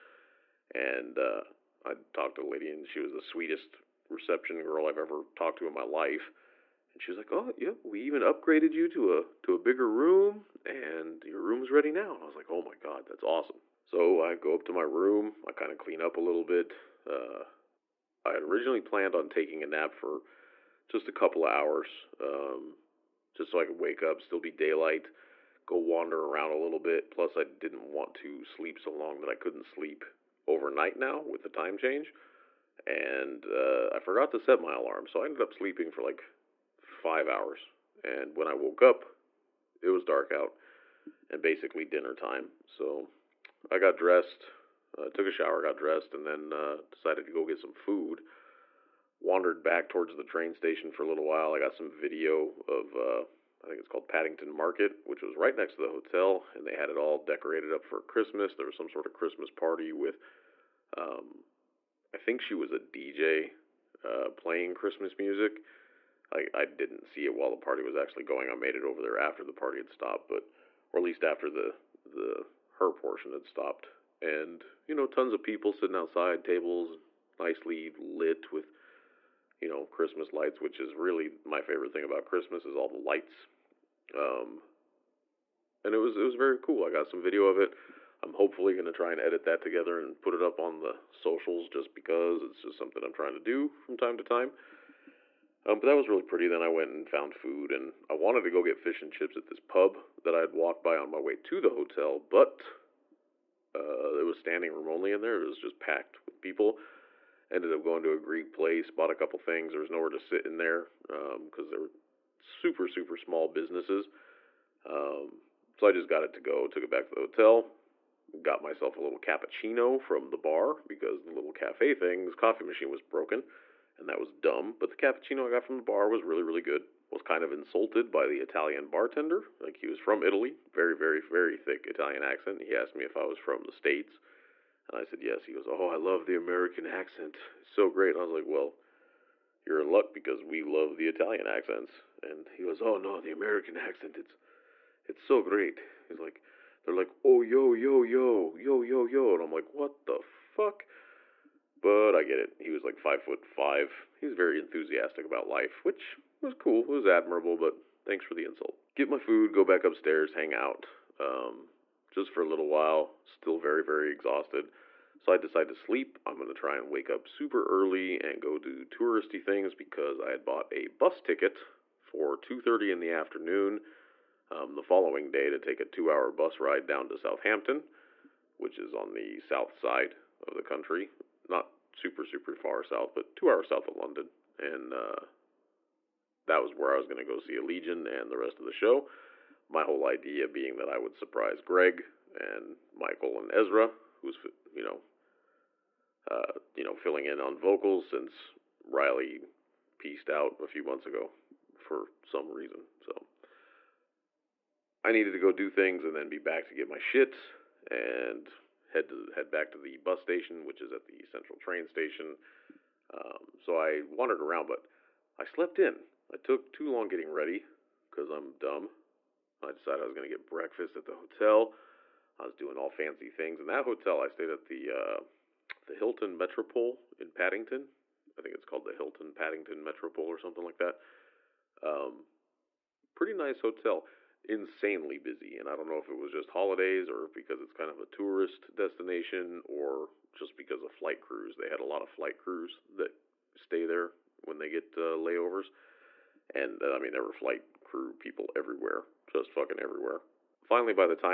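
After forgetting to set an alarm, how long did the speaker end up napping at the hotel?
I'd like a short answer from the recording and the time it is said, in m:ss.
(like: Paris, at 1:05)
5 hours, at 0:36.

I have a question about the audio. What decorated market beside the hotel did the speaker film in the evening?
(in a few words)
Paddington Market.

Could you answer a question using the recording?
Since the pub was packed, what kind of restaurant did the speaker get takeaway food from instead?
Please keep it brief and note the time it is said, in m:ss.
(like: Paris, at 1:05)
Greek, at 1:48.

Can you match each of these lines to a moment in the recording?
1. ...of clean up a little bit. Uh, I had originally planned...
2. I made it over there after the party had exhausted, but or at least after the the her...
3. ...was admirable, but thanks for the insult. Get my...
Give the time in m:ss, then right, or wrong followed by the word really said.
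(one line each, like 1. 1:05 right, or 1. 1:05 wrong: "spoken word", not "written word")
1. 0:15 right
2. 1:08 wrong: "stopped", not "exhausted"
3. 2:36 right.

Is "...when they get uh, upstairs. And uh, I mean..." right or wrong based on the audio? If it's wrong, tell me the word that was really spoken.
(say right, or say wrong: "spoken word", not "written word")
wrong: "layovers", not "upstairs".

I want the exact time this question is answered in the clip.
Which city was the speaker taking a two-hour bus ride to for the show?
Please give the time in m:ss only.
2:57.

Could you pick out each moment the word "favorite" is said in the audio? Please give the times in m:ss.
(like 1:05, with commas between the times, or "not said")
1:21.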